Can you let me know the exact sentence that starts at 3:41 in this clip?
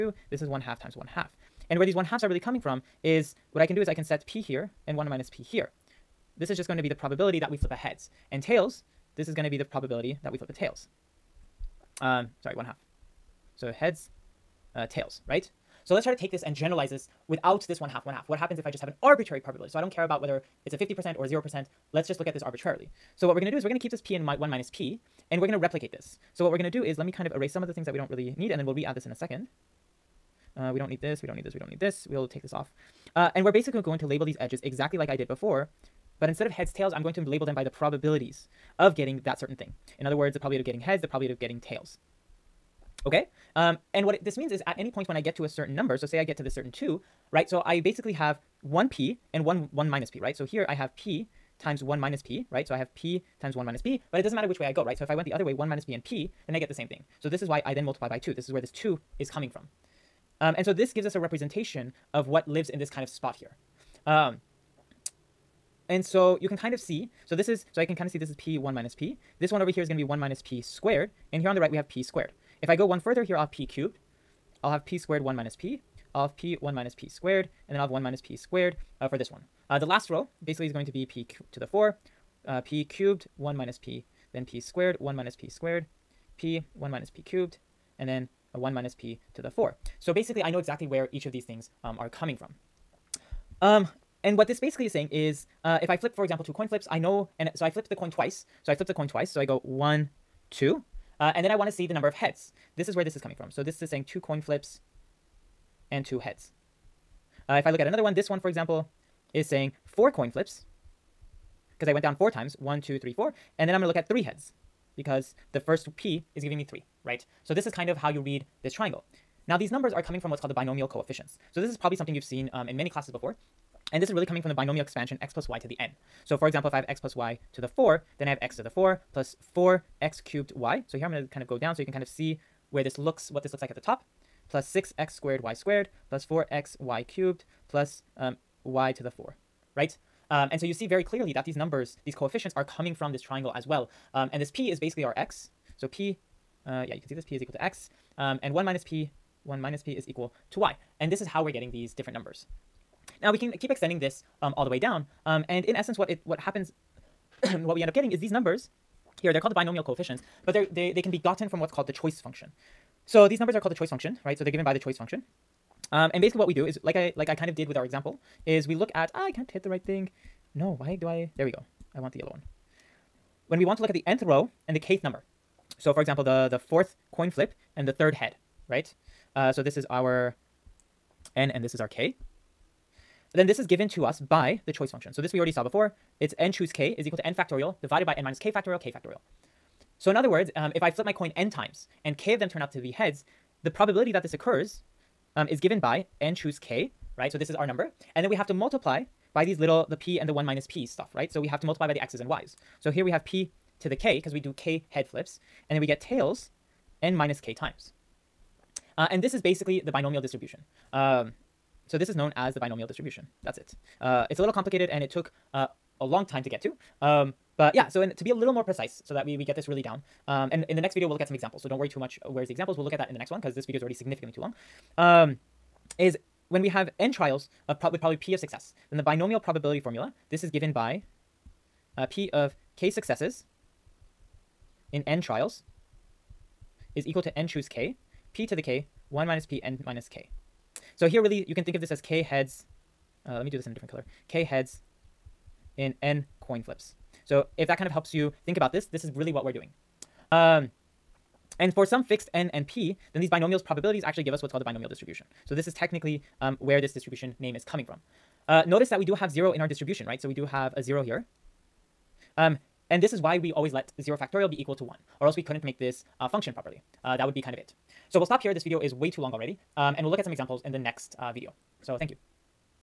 So don't worry too much uh, where's the examples.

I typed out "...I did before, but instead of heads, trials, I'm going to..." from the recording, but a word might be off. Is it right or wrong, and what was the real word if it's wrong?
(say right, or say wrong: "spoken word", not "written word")
wrong: "tails", not "trials".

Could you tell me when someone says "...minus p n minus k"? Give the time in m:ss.
3:59.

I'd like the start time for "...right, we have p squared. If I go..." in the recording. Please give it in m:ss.
1:11.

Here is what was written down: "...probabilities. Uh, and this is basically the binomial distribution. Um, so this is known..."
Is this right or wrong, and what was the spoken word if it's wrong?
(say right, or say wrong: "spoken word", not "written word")
wrong: "times", not "probabilities".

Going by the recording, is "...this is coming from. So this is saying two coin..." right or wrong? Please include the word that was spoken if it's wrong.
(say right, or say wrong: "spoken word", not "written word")
right.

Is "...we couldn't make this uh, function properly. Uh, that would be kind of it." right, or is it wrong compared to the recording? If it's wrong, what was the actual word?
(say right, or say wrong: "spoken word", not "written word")
right.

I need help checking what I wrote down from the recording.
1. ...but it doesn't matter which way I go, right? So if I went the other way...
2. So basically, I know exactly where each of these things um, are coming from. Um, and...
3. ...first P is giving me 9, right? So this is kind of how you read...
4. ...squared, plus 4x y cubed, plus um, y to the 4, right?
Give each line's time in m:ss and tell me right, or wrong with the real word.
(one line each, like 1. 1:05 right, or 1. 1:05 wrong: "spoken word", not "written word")
1. 0:54 right
2. 1:29 right
3. 1:55 wrong: "3", not "9"
4. 2:15 right.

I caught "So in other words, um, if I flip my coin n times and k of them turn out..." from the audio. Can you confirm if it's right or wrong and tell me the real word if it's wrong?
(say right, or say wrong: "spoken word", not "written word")
right.